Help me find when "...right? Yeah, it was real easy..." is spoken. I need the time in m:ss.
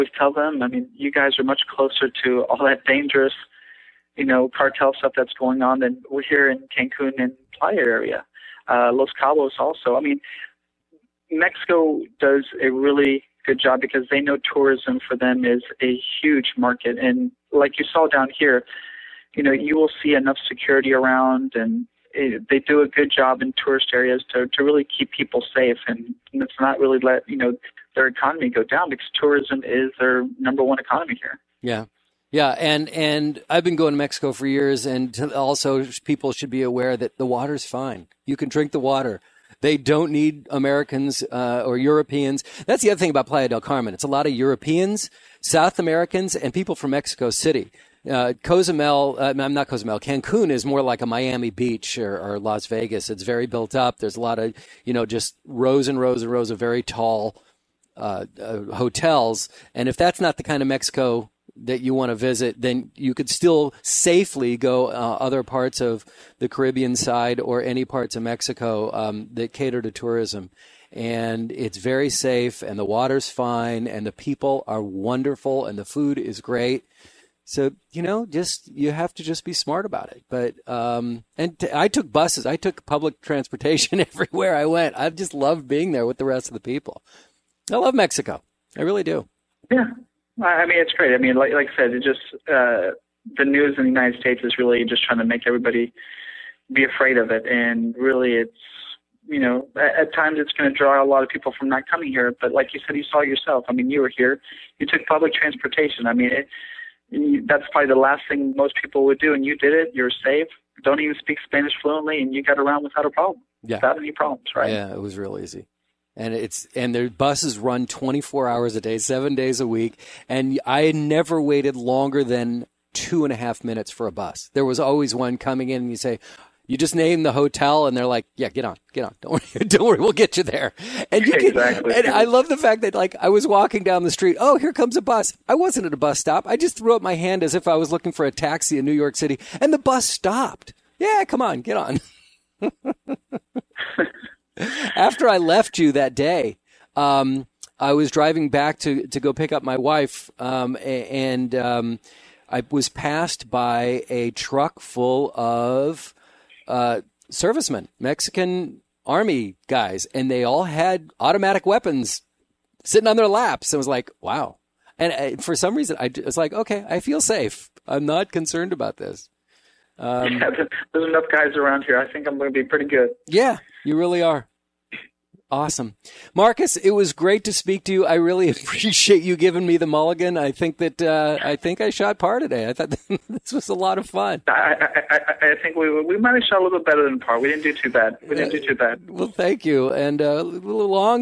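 1:54.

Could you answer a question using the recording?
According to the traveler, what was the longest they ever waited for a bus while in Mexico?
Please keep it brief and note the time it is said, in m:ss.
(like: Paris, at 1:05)
2.5 minutes, at 2:02.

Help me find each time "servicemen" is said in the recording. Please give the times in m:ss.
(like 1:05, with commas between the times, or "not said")
2:37.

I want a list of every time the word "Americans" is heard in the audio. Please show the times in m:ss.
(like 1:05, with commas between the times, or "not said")
0:40, 0:45.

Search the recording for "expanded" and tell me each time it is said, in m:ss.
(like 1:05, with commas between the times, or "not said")
not said.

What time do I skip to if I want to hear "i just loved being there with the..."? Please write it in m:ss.
1:24.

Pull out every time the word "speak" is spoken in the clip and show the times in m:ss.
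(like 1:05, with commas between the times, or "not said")
1:51, 2:57.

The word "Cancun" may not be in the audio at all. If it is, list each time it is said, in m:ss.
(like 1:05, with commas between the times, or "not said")
0:06, 0:50.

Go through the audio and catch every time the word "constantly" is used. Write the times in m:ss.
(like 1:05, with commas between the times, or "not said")
not said.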